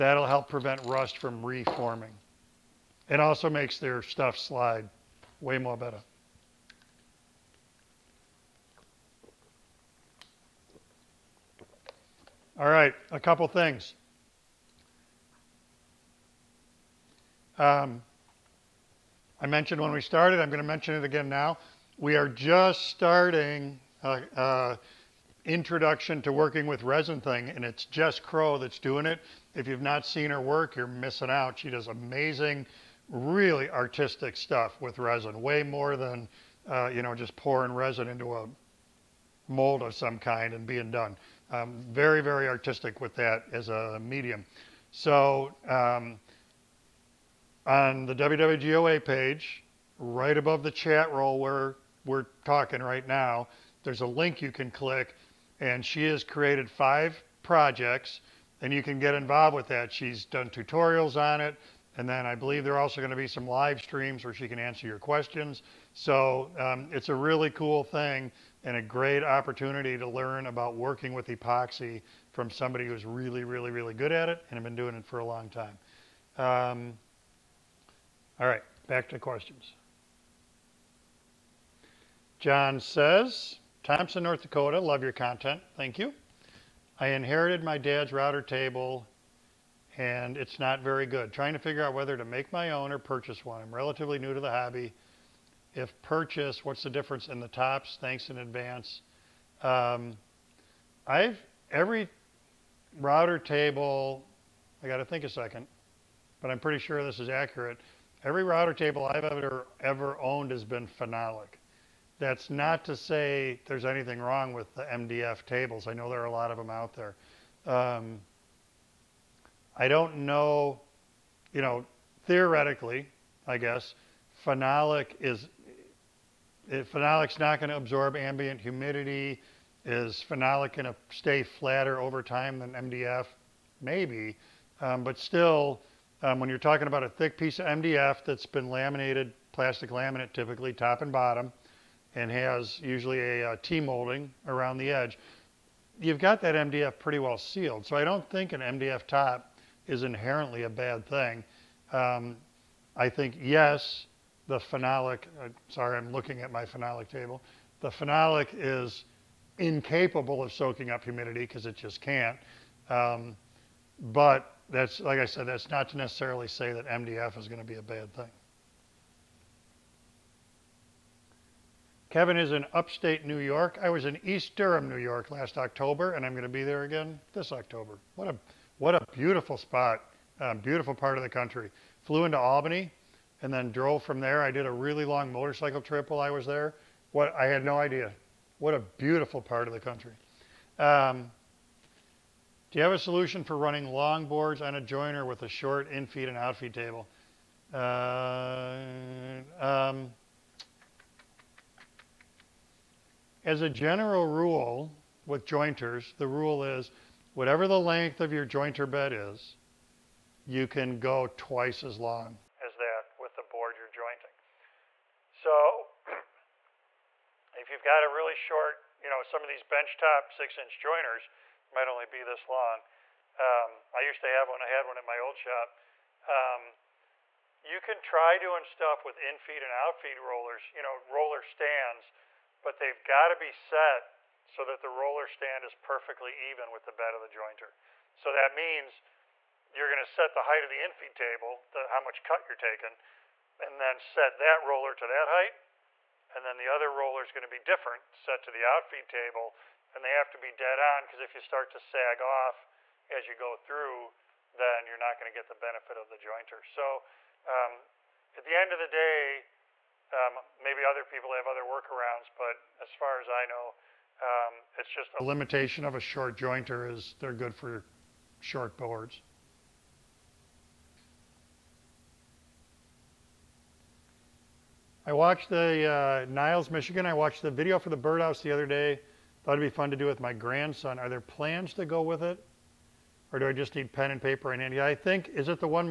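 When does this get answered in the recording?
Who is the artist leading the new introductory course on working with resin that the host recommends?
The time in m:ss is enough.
0:27.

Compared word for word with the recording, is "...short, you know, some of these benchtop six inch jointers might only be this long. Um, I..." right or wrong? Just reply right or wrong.
right.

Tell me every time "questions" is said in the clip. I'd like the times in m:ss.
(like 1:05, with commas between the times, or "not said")
1:04, 1:19.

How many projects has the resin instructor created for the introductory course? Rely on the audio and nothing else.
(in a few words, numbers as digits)
5.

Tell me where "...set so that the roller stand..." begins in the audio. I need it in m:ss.
3:53.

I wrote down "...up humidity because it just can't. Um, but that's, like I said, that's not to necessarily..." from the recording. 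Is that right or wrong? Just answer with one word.
right.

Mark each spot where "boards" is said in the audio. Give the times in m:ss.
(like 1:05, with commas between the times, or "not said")
3:14, 3:33, 4:28.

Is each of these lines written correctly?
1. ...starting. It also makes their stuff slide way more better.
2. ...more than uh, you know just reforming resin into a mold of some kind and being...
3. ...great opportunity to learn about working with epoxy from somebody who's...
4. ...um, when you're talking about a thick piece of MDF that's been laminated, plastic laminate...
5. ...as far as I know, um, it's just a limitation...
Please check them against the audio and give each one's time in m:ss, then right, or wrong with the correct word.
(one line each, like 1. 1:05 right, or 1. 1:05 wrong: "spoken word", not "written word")
1. 0:01 wrong: "reforming", not "starting"
2. 0:35 wrong: "pouring", not "reforming"
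3. 1:08 right
4. 2:16 right
5. 4:22 right.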